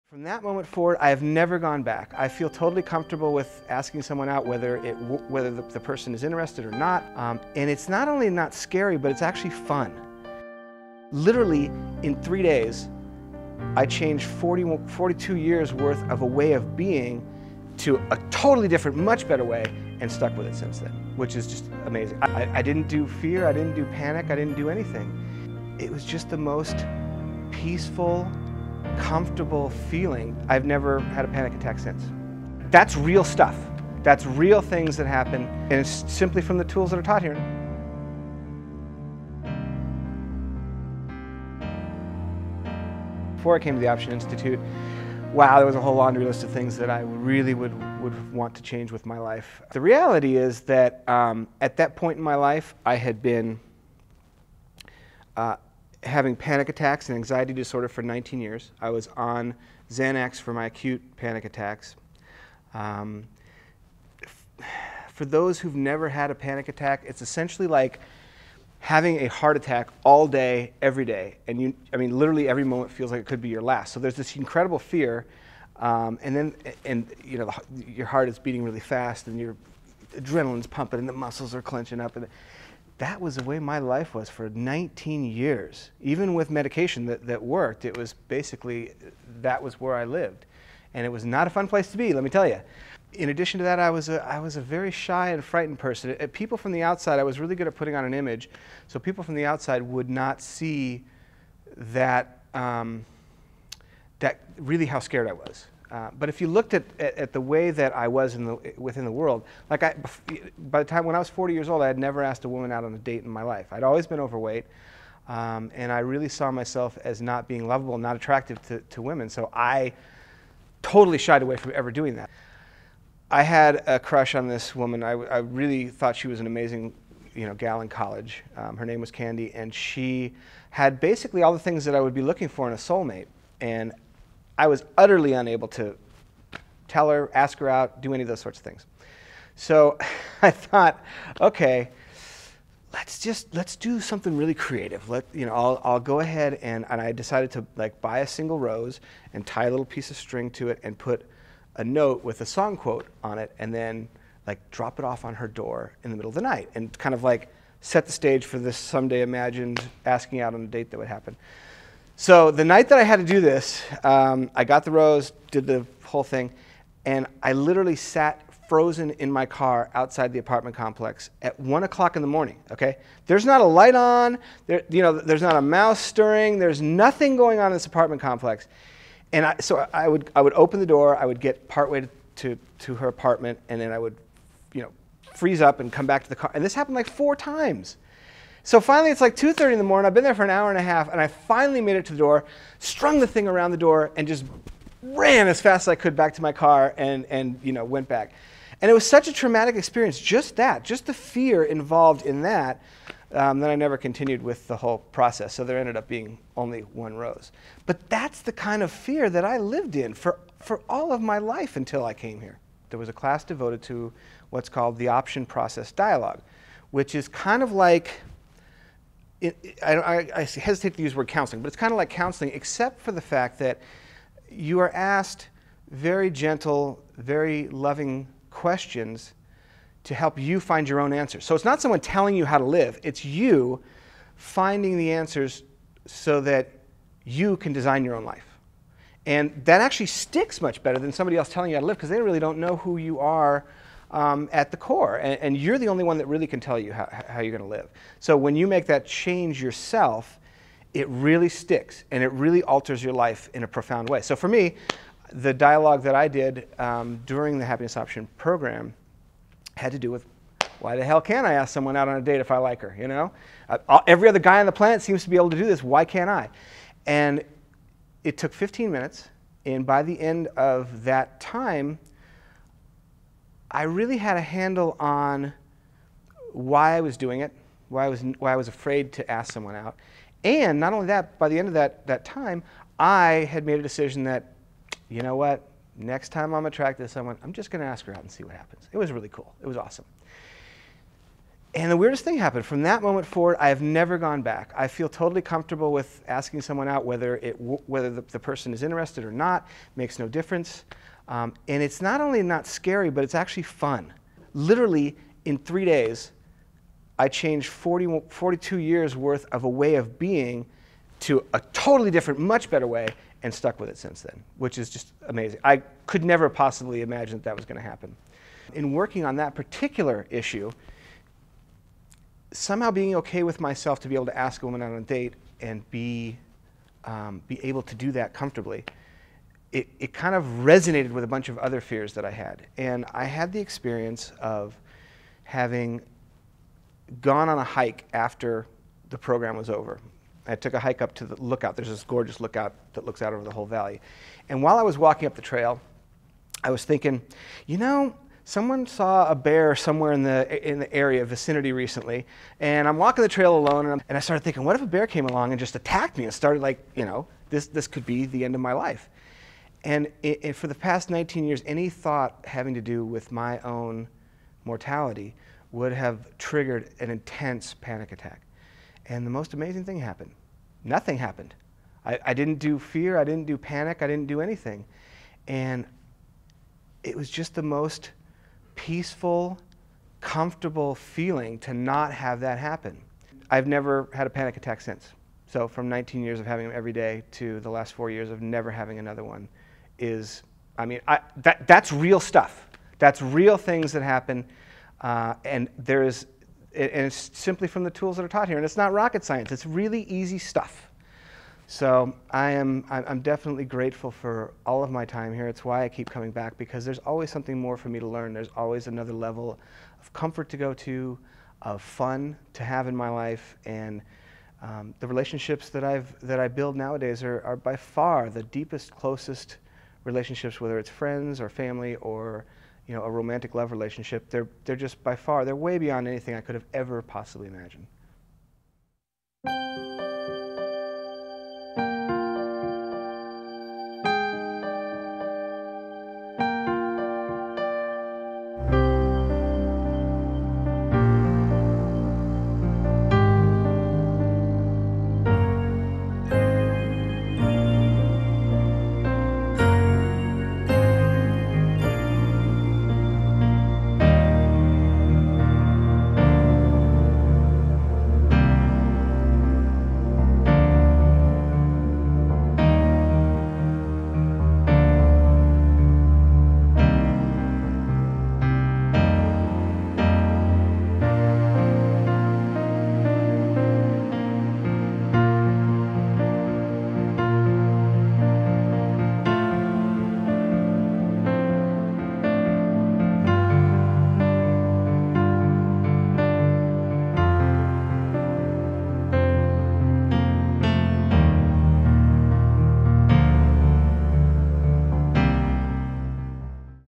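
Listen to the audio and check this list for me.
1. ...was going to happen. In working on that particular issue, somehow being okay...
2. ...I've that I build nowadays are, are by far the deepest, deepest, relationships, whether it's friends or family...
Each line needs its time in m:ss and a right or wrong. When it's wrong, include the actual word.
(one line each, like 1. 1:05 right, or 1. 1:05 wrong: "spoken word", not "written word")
1. 5:17 right
2. 6:55 wrong: "closest", not "deepest".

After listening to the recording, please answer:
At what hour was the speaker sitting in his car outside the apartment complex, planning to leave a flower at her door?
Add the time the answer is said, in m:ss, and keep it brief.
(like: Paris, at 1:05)
1 o'clock in the morning, at 2:51.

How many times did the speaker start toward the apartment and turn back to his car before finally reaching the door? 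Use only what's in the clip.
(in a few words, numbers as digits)
4 times.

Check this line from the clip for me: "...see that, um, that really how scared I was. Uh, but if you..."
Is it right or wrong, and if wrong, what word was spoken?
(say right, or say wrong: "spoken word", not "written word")
right.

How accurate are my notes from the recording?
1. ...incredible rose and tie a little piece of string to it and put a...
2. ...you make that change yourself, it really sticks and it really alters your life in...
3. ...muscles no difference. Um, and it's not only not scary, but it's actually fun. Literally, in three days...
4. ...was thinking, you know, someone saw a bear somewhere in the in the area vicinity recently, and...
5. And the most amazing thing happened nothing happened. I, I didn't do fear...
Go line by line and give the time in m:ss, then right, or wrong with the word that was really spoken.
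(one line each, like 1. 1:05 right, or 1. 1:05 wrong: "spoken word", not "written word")
1. 2:28 wrong: "single", not "incredible"
2. 4:08 right
3. 4:59 wrong: "makes", not "muscles"
4. 5:46 right
5. 6:09 right.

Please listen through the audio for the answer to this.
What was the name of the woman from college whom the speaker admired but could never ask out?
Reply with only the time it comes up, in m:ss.
2:09.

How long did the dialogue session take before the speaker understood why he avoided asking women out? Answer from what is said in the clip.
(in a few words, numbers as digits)
15 minutes.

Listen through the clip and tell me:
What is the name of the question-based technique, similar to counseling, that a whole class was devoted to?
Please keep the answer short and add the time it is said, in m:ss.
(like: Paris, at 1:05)
Option process dialogue, at 3:35.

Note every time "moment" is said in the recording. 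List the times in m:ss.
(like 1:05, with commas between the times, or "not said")
0:00, 1:12, 4:53.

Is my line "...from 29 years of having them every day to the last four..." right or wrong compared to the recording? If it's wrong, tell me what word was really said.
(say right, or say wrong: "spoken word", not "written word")
wrong: "19", not "29".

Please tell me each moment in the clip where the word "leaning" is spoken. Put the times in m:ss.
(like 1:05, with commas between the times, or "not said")
not said.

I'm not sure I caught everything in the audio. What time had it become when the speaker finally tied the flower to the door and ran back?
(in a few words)
2:30 in the morning.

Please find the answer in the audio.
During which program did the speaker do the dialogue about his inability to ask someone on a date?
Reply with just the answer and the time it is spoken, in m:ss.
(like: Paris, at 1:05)
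Happiness Option Program, at 4:17.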